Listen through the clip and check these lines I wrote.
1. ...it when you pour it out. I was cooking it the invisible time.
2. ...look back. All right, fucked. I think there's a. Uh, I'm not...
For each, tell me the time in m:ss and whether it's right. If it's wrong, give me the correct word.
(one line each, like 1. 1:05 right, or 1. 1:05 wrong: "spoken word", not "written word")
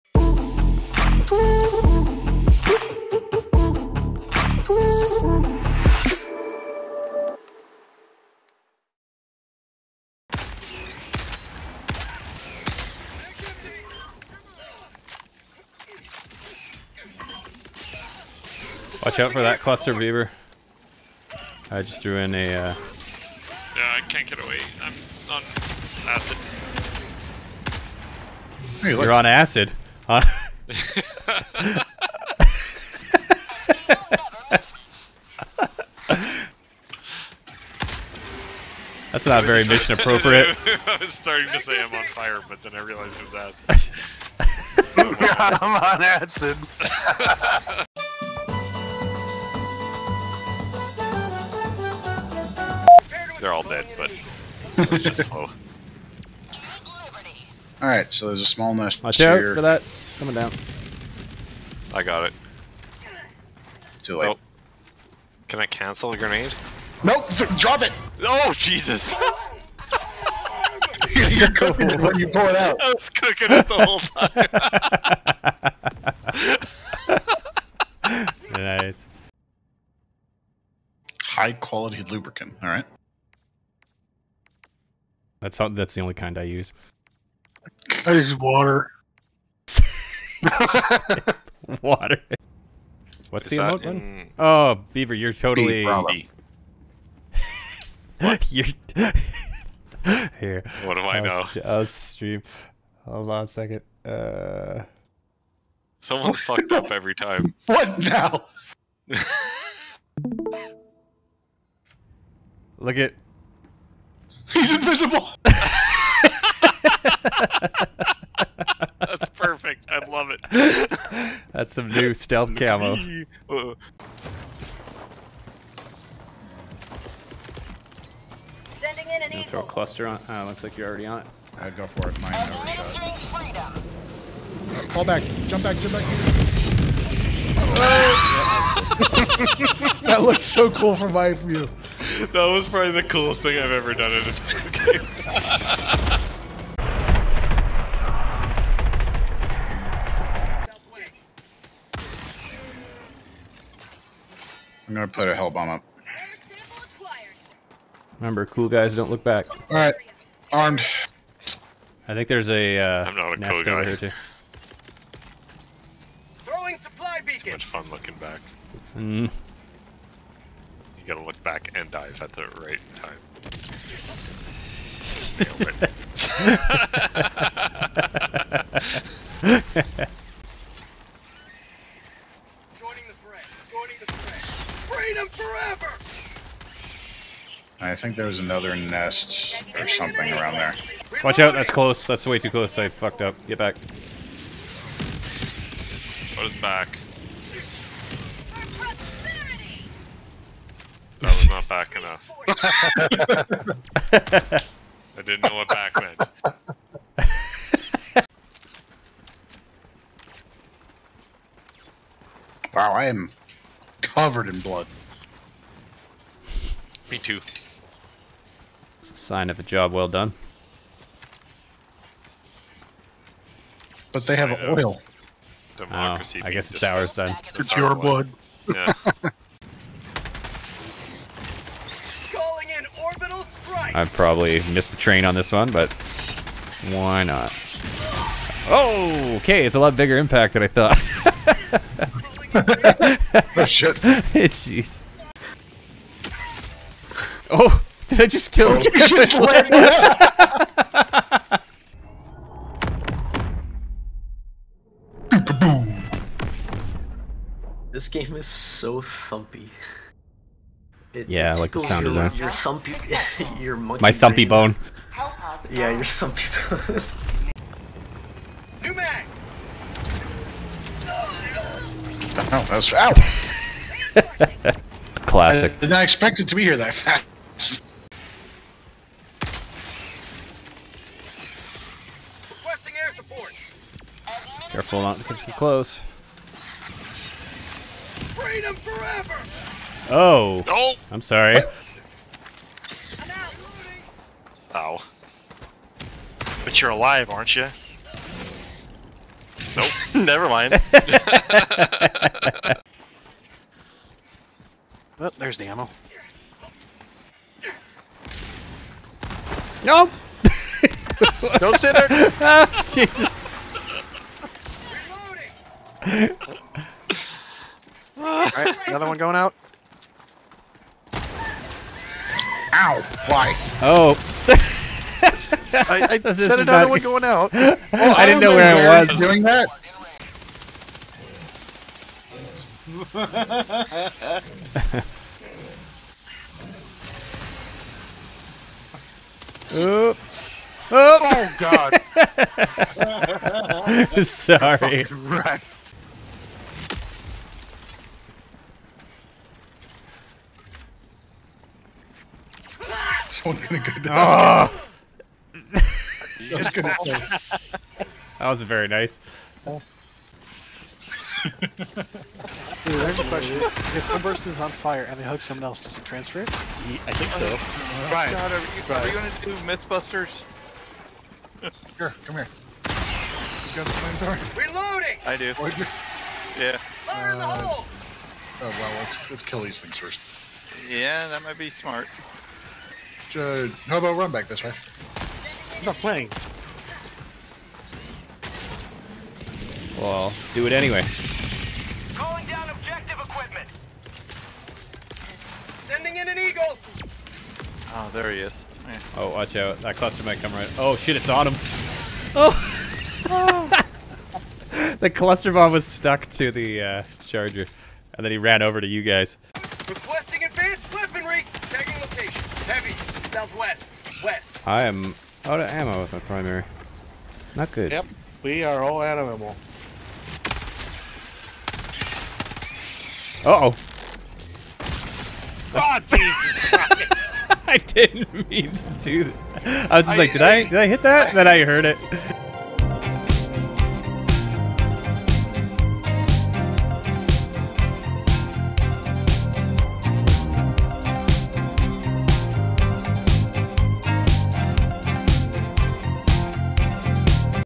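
1. 1:11 wrong: "whole", not "invisible"
2. 2:39 wrong: "armed", not "fucked".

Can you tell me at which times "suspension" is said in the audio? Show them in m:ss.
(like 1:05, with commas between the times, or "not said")
not said.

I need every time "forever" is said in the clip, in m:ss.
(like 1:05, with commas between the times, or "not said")
3:05, 4:48.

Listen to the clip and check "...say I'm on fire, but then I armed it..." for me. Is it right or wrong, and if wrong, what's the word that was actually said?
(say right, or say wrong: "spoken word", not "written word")
wrong: "realized", not "armed".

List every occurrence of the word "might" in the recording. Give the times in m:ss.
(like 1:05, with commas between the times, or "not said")
6:21, 6:40.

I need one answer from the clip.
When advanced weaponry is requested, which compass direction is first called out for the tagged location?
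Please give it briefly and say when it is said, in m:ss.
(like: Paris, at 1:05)
Southwest, at 6:53.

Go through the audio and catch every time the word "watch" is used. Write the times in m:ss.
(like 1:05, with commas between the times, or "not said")
0:19, 0:59, 3:11, 6:39.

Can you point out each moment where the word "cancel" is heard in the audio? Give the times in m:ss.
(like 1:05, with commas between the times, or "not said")
1:05.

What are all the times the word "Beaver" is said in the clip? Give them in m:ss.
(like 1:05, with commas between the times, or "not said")
0:19, 1:34.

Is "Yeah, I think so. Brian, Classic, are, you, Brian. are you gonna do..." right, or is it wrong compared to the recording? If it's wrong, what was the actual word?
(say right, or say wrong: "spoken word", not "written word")
wrong: "God", not "Classic".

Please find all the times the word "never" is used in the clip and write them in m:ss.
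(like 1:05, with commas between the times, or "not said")
2:12, 5:00.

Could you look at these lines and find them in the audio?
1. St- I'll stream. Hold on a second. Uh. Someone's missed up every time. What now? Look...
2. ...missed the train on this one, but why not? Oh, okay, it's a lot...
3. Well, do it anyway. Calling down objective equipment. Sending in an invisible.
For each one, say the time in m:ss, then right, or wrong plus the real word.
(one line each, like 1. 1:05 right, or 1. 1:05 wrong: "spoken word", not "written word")
1. 1:41 wrong: "fucked", not "missed"
2. 3:54 right
3. 6:29 wrong: "eagle", not "invisible".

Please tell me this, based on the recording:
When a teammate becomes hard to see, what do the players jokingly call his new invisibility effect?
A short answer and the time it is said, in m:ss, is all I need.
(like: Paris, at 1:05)
Stealth camo, at 2:01.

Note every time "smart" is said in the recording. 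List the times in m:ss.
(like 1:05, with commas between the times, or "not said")
6:21.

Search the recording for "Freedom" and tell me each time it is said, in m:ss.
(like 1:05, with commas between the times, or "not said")
3:04, 4:48.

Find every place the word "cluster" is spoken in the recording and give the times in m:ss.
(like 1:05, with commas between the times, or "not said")
0:19, 2:09, 6:39, 6:45.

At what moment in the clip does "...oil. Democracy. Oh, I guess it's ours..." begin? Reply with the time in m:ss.
3:44.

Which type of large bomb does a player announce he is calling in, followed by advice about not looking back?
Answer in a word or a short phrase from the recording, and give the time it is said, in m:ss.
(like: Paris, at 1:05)
Hell bomb, at 2:35.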